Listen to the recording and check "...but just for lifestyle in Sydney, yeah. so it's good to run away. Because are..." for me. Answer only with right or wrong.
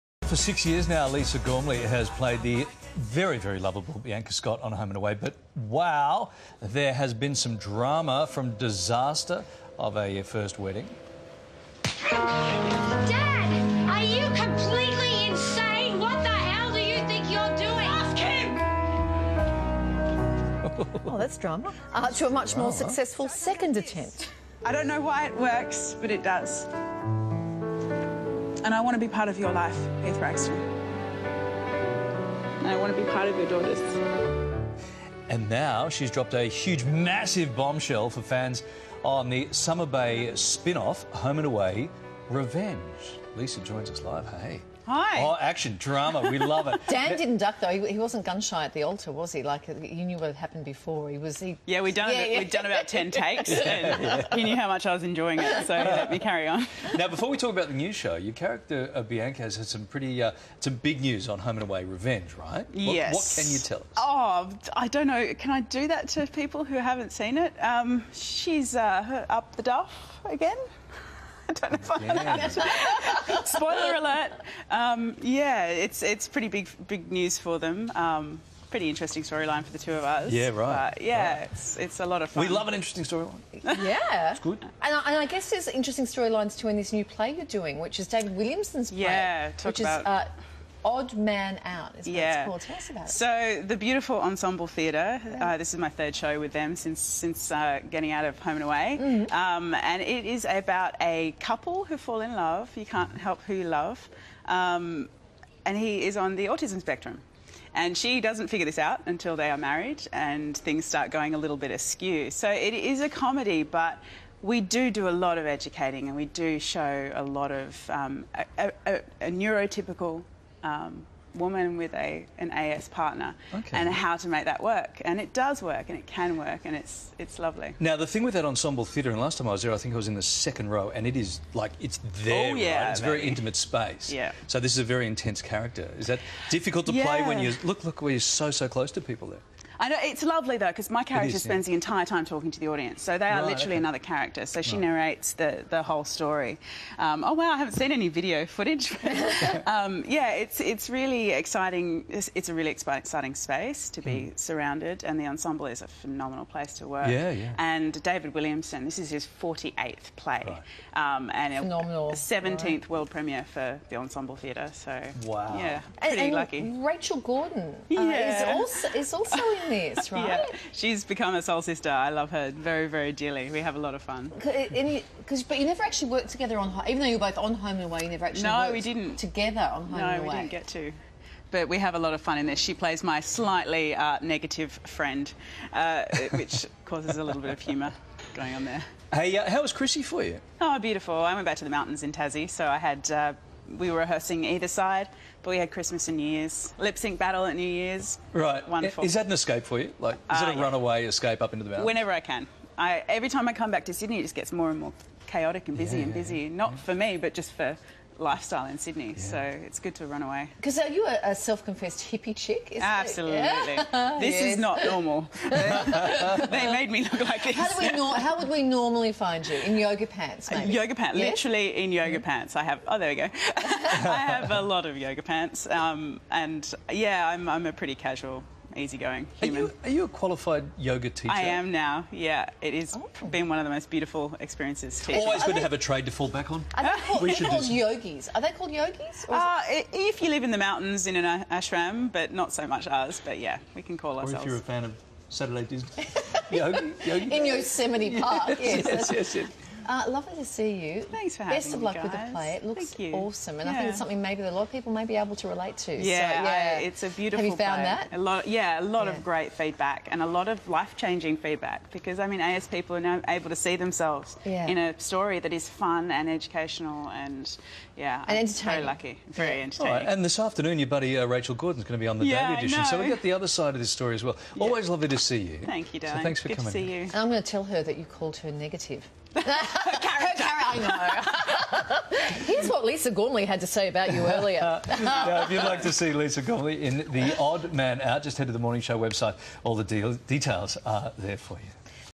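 right.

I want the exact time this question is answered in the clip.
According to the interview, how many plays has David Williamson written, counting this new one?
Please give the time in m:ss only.
2:39.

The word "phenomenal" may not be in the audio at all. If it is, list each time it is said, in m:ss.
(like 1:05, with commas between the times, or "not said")
2:35, 2:41.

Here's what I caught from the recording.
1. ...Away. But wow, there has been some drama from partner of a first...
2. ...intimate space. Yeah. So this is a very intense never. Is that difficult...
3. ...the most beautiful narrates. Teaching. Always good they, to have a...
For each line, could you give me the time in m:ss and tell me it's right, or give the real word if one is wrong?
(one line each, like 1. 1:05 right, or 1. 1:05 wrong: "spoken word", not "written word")
1. 0:04 wrong: "disaster", not "partner"
2. 2:13 wrong: "character", not "never"
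3. 3:53 wrong: "experiences", not "narrates".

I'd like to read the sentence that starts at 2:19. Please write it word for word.
I know it's lovely though because my character is, spends yeah.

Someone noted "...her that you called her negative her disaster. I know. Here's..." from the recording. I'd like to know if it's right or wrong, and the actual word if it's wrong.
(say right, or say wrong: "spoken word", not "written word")
wrong: "character", not "disaster".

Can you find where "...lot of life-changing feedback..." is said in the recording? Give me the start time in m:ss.
4:20.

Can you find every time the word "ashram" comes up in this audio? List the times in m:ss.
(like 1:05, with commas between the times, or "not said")
4:01.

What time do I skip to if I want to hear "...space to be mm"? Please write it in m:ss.
2:33.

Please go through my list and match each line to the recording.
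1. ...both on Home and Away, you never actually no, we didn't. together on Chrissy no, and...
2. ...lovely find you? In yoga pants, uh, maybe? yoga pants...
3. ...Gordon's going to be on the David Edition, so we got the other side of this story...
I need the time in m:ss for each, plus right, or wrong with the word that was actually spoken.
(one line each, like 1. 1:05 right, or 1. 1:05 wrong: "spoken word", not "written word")
1. 2:57 wrong: "Home", not "Chrissy"
2. 3:38 wrong: "normally", not "lovely"
3. 4:31 wrong: "Daily", not "David".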